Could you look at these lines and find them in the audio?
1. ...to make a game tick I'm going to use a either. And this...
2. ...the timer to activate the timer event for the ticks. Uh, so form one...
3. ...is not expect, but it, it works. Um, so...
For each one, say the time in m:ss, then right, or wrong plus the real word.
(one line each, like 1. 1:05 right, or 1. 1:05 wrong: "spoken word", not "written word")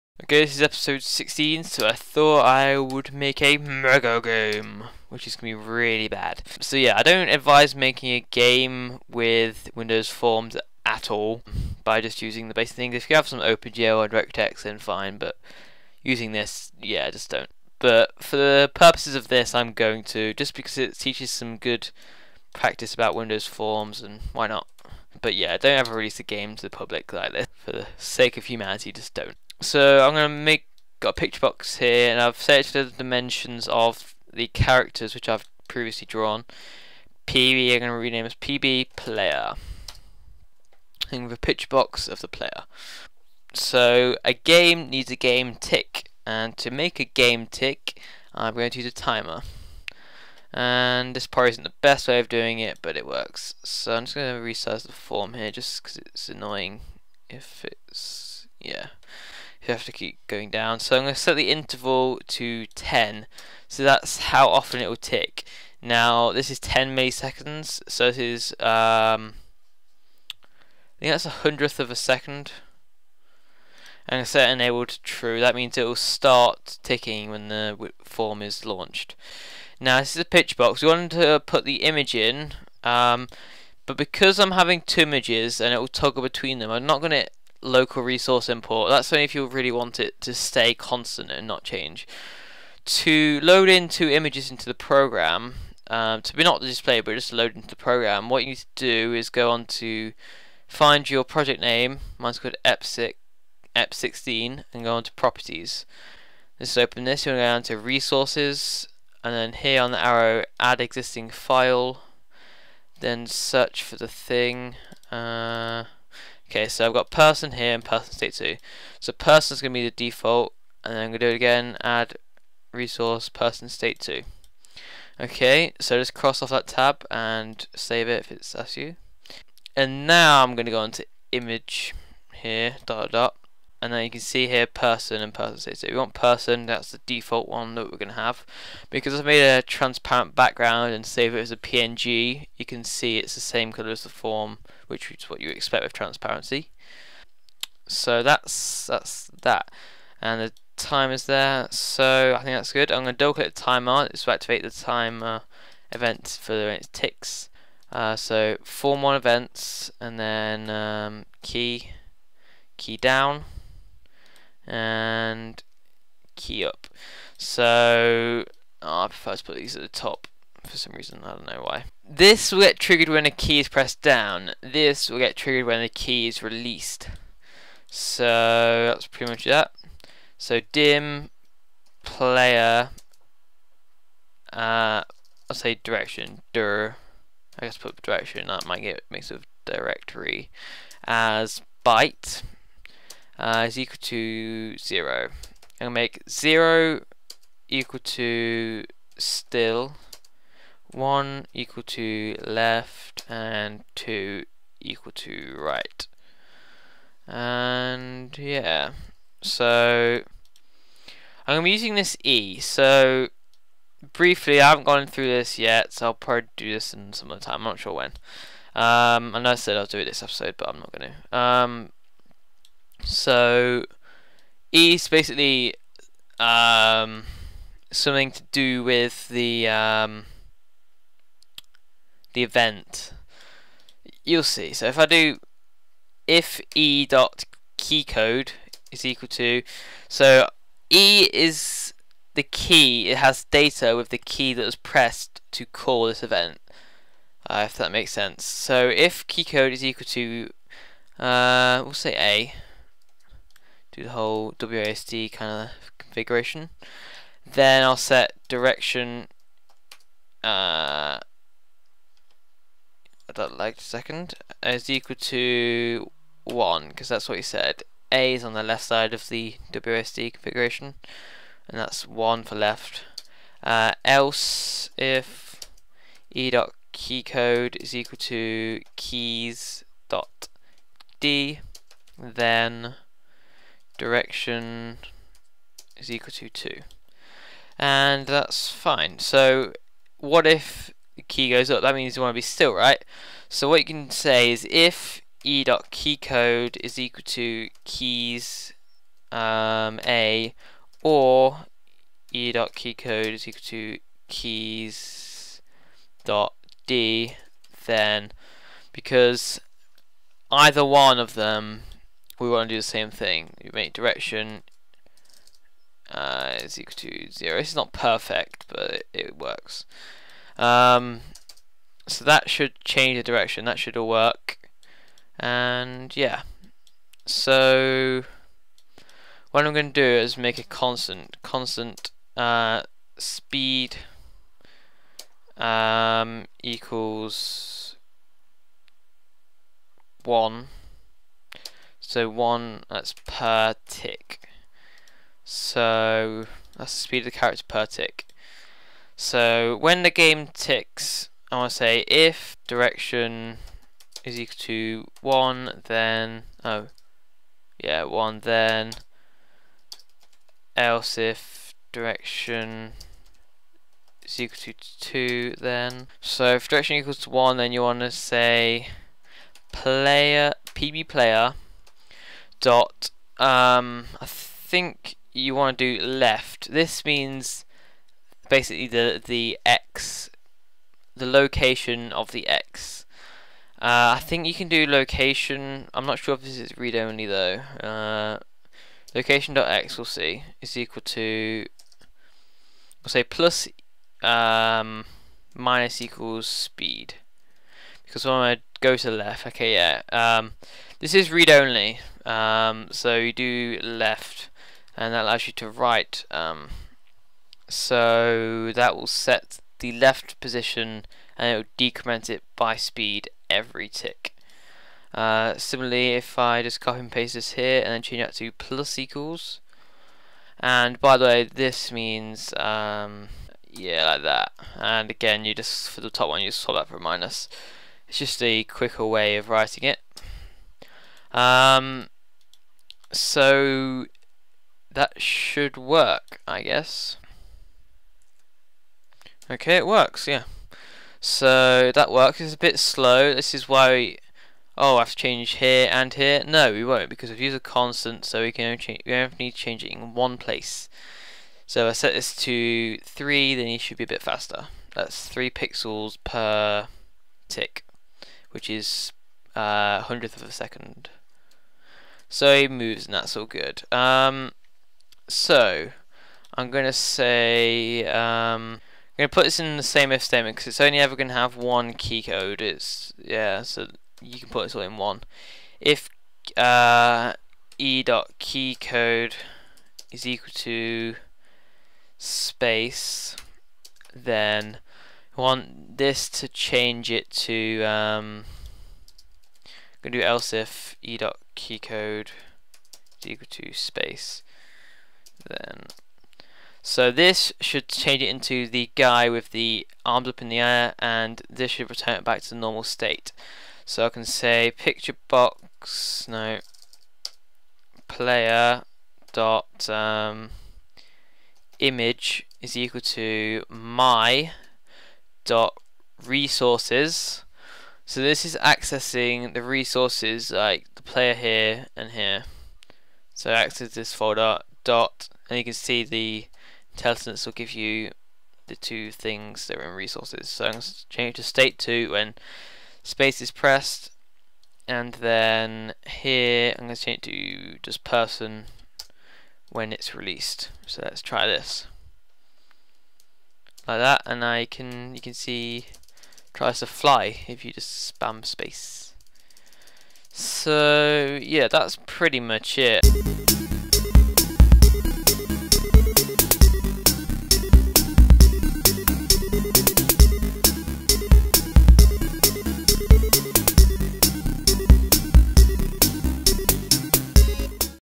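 1. 0:46 wrong: "timer", not "either"
2. 2:33 right
3. 5:17 wrong: "perfect", not "expect".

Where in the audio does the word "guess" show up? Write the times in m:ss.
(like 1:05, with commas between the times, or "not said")
3:07, 7:16.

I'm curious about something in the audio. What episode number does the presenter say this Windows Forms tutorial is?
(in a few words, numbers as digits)
16.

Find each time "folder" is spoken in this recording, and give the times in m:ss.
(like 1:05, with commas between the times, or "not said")
8:44.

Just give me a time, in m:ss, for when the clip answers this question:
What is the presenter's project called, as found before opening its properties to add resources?
1:43.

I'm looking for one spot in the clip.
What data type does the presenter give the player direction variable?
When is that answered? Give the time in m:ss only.
3:11.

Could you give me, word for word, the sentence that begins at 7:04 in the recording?
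And again, you just for the top one, you just swap that for a minus.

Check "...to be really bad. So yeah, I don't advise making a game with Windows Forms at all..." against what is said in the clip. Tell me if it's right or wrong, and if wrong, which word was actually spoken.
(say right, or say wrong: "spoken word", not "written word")
right.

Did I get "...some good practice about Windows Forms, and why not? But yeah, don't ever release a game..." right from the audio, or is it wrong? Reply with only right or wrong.
right.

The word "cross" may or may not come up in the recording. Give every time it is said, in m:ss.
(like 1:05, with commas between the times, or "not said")
2:06.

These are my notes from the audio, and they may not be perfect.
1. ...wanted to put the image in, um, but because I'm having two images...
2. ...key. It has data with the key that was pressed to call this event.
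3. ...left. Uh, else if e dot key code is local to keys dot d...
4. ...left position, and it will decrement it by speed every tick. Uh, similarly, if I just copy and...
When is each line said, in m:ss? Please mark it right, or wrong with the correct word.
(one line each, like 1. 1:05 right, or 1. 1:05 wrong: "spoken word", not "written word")
1. 1:20 right
2. 4:02 right
3. 4:32 wrong: "equal", not "local"
4. 6:49 right.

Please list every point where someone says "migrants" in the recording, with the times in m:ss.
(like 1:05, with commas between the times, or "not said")
not said.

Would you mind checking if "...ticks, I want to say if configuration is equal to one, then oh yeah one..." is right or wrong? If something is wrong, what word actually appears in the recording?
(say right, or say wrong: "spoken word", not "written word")
wrong: "direction", not "configuration".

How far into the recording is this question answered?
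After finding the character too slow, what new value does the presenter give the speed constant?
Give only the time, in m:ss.
7:31.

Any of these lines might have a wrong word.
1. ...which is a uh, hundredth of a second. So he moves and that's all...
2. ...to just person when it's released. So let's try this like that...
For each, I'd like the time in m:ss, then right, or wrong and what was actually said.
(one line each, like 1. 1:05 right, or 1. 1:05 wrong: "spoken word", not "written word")
1. 7:38 right
2. 8:57 right.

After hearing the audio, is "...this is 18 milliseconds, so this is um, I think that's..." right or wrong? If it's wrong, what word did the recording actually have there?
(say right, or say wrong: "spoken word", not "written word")
wrong: "10", not "18".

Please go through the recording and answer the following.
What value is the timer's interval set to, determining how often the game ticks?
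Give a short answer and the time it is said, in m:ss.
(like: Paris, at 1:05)
10, at 1:01.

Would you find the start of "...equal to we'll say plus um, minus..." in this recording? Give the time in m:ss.
6:30.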